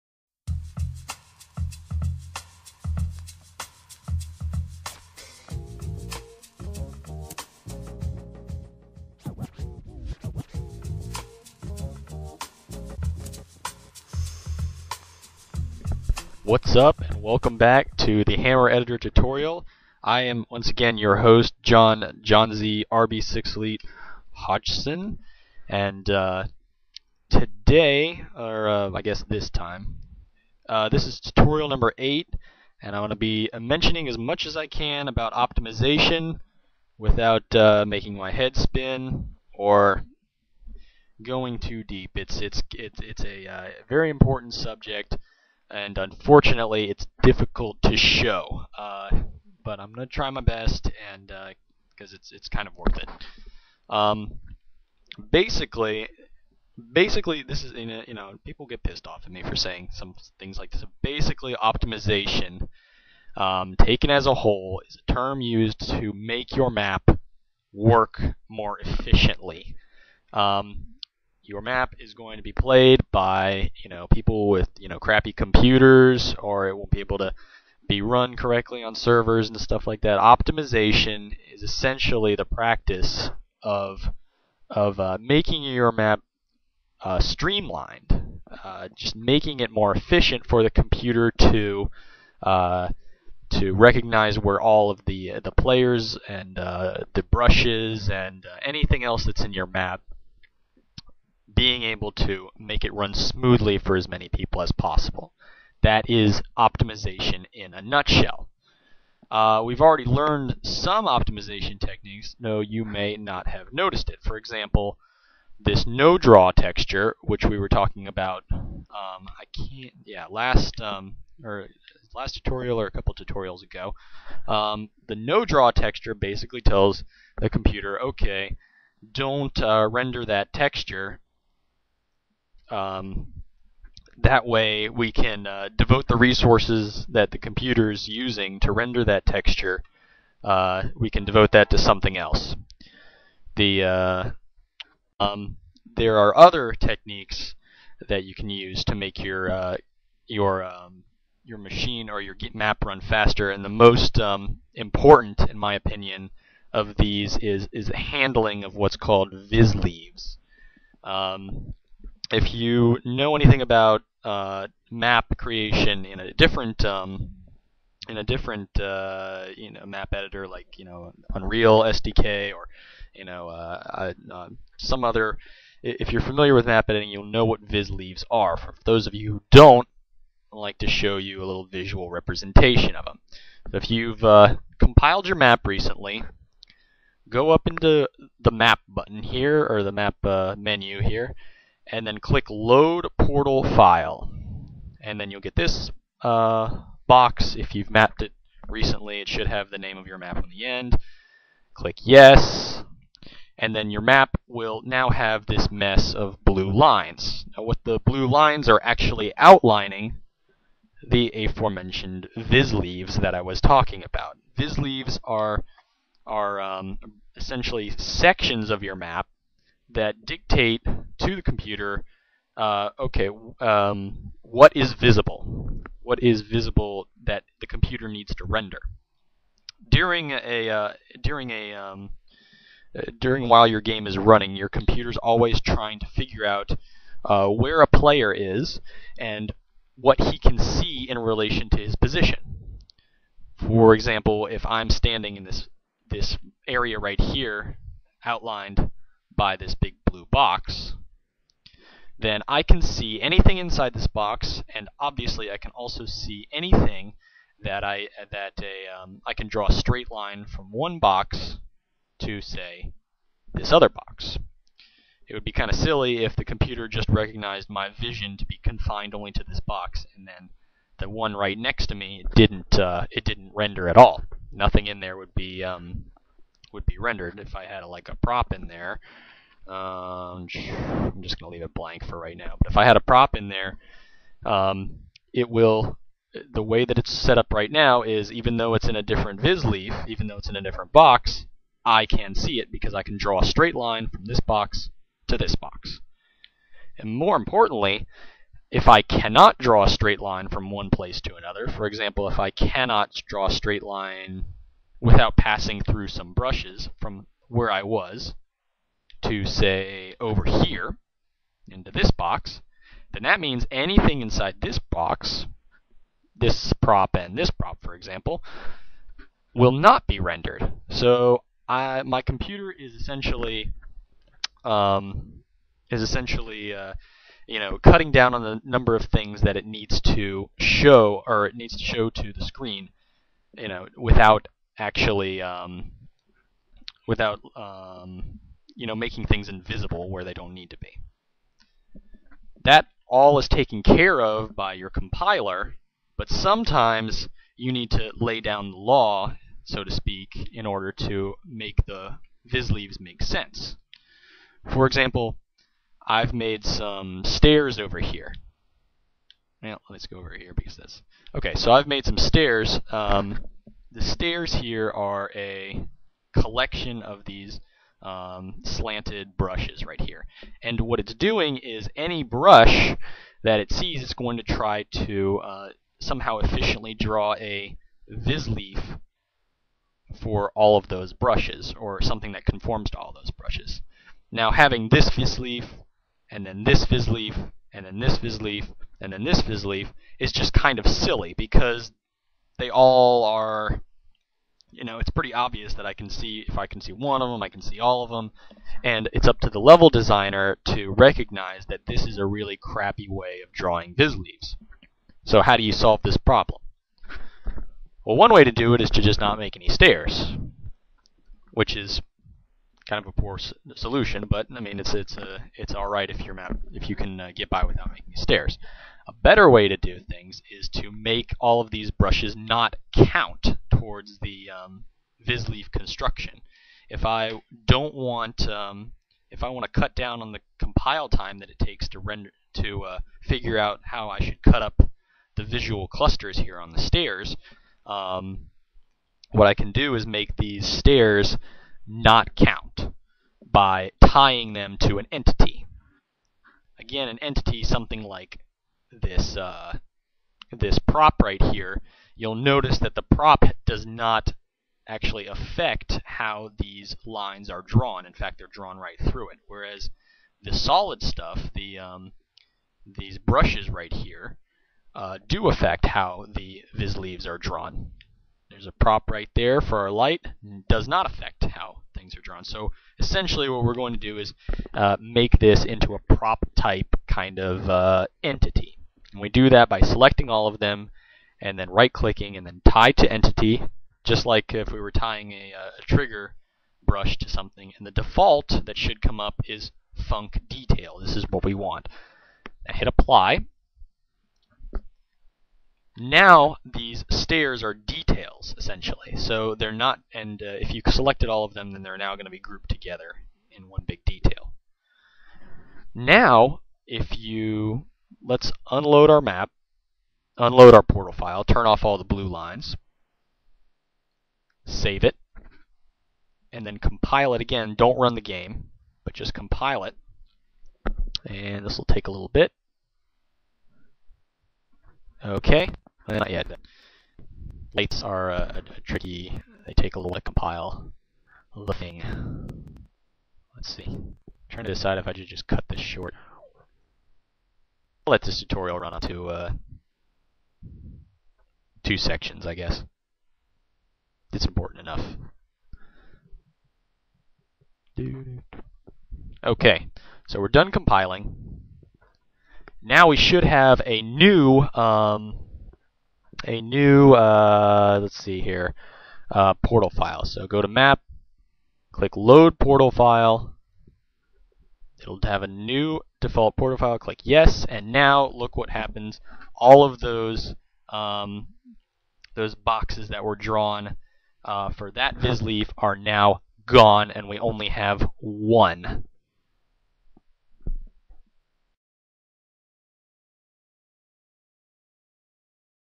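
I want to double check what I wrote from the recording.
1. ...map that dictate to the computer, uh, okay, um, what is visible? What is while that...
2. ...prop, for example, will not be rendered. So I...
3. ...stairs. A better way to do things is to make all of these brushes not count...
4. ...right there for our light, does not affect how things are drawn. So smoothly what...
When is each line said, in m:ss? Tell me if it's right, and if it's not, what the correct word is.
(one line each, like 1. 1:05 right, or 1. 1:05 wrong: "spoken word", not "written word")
1. 3:38 wrong: "visible", not "while"
2. 5:17 right
3. 6:58 right
4. 7:49 wrong: "essentially", not "smoothly".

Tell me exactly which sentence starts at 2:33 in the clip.
And the most um, important, in my opinion, of these is is the handling of what's called vis leaves.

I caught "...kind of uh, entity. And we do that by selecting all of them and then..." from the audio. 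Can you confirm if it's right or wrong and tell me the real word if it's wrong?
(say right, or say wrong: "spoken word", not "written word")
right.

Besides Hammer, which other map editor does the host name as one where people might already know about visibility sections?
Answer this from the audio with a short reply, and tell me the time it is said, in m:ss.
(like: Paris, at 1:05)
Unreal SDK, at 2:51.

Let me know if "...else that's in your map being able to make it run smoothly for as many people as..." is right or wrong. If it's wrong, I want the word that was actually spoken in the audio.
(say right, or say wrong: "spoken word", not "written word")
right.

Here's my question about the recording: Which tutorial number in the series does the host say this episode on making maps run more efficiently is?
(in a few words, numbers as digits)
8.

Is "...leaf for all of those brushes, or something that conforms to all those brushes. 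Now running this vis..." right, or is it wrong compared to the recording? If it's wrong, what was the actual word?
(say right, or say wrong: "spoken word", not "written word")
wrong: "having", not "running".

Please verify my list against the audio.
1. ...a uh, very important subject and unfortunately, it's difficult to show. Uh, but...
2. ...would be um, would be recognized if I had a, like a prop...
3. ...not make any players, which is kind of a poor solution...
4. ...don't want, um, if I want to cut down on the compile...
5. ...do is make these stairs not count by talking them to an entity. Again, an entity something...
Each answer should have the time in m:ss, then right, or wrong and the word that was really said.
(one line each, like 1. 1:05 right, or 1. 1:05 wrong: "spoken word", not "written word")
1. 0:43 right
2. 4:35 wrong: "rendered", not "recognized"
3. 6:49 wrong: "stairs", not "players"
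4. 7:07 right
5. 7:19 wrong: "tying", not "talking".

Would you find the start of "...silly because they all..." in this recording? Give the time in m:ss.
6:30.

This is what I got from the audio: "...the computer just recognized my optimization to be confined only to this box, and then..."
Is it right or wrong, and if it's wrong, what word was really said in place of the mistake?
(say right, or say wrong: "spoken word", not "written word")
wrong: "vision", not "optimization".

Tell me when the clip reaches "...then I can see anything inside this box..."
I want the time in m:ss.
4:12.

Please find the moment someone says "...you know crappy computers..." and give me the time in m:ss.
1:14.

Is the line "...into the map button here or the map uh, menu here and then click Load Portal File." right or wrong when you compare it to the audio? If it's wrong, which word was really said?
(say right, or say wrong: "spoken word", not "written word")
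right.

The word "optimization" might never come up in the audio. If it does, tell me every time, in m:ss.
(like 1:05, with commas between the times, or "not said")
0:35, 1:01, 1:20, 1:46, 1:51.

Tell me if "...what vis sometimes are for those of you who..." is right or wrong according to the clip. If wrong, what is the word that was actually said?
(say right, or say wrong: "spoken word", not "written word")
wrong: "leaves", not "sometimes".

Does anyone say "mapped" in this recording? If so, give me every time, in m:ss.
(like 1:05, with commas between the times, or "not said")
3:17.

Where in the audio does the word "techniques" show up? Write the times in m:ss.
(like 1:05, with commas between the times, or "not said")
1:51, 2:26.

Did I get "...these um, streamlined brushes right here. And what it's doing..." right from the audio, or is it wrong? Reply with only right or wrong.
wrong.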